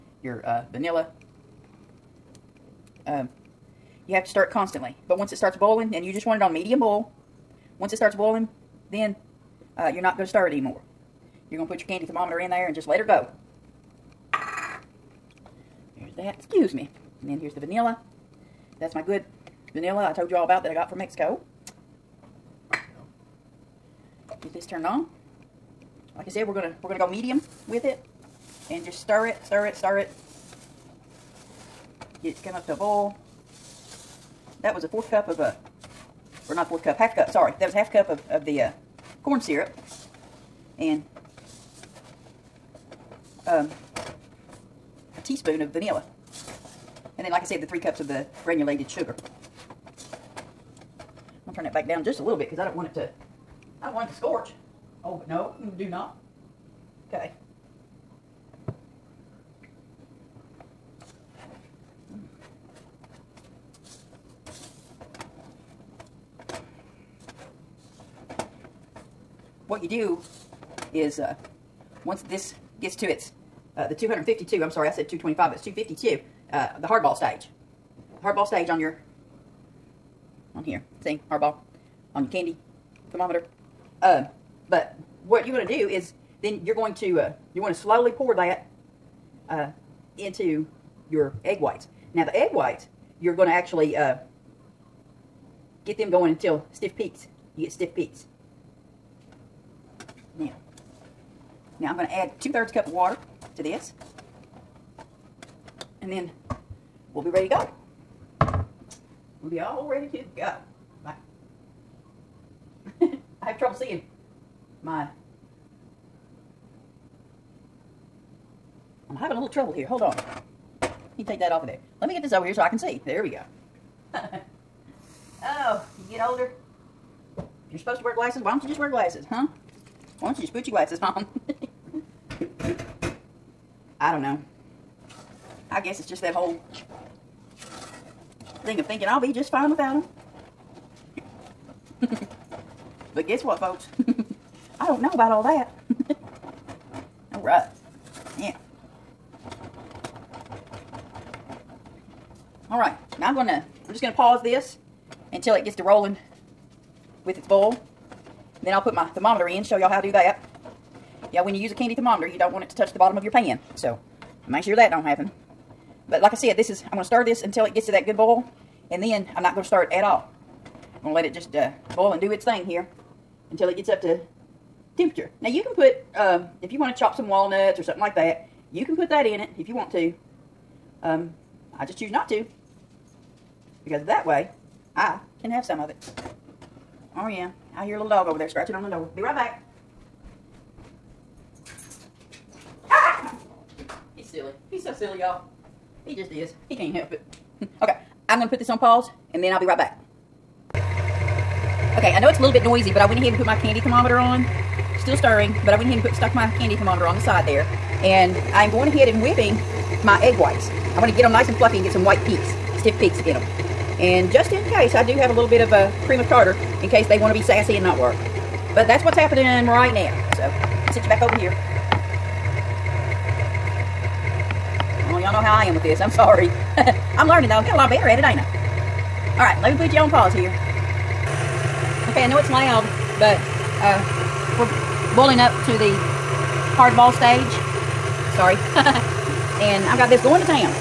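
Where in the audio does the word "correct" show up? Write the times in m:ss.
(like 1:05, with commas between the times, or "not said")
not said.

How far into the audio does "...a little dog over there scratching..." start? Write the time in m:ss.
3:07.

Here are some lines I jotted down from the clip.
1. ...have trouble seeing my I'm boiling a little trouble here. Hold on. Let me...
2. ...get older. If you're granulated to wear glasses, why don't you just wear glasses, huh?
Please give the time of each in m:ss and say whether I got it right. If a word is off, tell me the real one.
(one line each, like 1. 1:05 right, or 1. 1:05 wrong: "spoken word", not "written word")
1. 1:53 wrong: "having", not "boiling"
2. 2:06 wrong: "supposed", not "granulated".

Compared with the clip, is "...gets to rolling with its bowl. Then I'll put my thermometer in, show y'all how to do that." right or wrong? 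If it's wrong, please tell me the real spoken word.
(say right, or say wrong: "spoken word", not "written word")
right.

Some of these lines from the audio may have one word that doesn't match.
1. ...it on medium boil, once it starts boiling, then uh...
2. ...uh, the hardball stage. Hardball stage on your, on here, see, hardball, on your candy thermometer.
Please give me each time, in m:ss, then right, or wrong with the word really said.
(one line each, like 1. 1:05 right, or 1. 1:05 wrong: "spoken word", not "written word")
1. 0:06 right
2. 1:16 right.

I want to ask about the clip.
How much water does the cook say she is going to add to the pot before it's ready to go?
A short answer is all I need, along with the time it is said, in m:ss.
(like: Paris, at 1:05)
2/3 cup, at 1:42.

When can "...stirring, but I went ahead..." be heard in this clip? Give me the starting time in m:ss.
3:25.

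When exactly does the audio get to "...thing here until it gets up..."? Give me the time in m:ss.
2:52.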